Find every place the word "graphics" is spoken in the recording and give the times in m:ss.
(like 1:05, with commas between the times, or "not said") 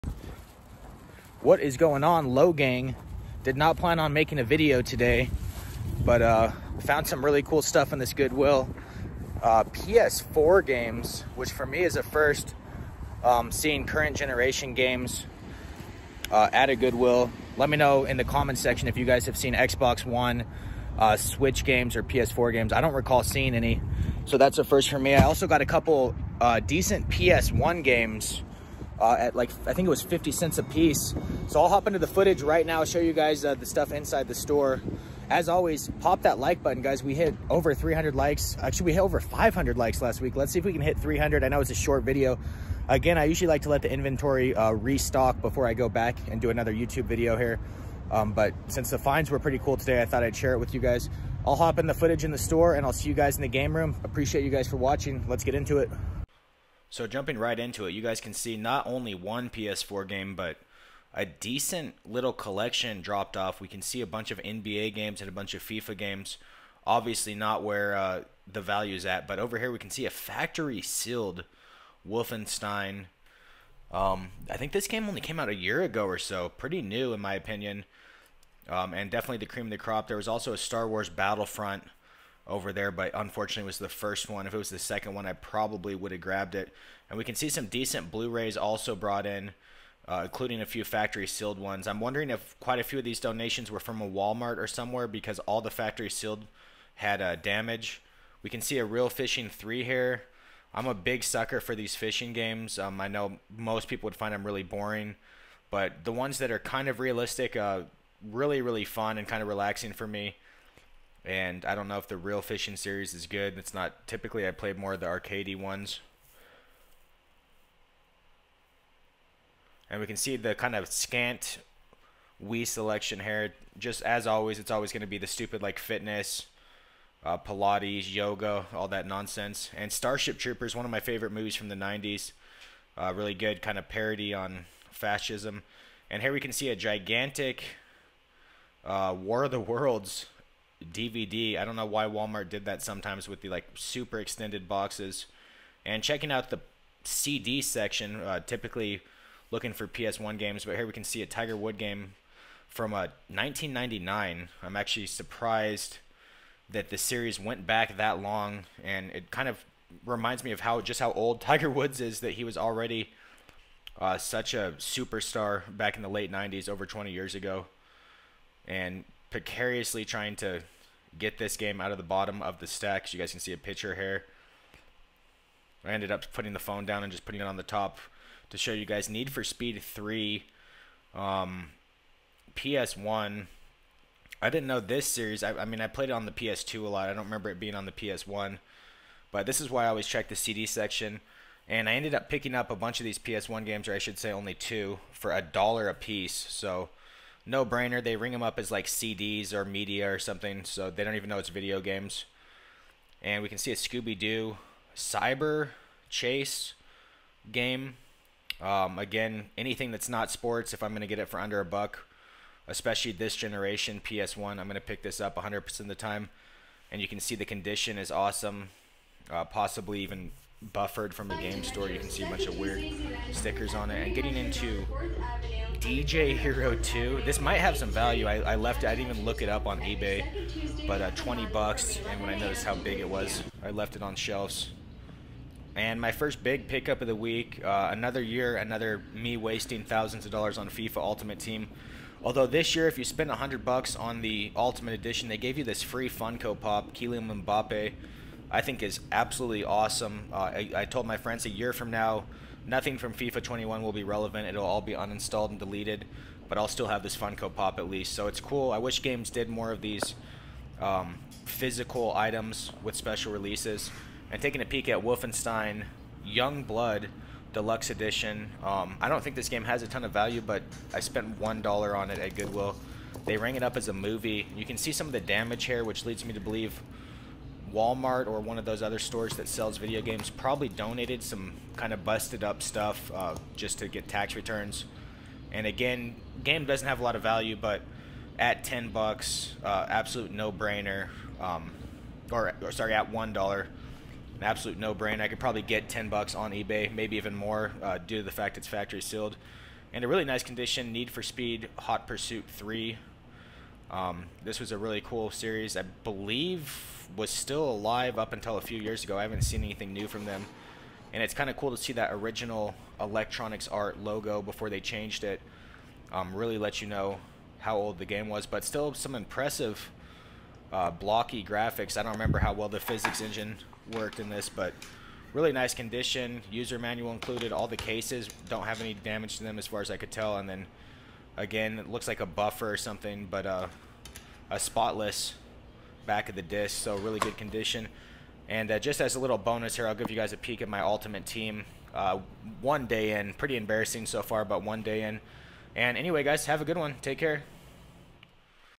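5:21.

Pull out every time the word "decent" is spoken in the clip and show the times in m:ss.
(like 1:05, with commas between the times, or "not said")
0:26, 1:01, 1:27.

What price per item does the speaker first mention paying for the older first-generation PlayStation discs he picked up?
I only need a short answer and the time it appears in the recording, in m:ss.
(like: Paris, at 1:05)
50 cents, at 0:30.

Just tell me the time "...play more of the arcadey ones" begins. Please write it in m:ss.
1:54.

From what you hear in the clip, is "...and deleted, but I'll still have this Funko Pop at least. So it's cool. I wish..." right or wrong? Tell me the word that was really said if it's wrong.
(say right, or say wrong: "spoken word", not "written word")
right.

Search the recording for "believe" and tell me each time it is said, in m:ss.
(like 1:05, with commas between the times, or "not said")
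4:36, 5:06.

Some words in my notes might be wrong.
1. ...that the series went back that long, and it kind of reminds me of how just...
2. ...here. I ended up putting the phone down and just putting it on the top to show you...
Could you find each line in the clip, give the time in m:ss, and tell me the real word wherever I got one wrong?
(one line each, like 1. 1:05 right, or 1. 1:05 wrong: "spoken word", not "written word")
1. 2:36 right
2. 2:53 right.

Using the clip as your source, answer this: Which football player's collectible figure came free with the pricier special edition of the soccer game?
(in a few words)
Kylian Mbappe.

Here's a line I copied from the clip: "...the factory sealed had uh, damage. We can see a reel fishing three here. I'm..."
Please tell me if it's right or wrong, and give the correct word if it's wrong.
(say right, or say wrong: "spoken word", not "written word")
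right.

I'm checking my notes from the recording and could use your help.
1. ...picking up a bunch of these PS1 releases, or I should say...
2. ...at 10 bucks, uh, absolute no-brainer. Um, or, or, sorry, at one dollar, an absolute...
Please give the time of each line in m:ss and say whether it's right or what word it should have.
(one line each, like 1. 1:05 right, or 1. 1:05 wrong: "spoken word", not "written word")
1. 3:12 wrong: "games", not "releases"
2. 4:48 right.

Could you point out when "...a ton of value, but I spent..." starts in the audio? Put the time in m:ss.
4:29.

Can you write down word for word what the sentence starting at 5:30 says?
And then Again, it looks like a buffer or something, but uh, a spotless back of the disc, so really good condition.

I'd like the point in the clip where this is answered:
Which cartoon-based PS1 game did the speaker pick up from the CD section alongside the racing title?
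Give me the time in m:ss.
3:23.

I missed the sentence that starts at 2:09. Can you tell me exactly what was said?
And Starship Troopers, one of my favorite movies from the 90s.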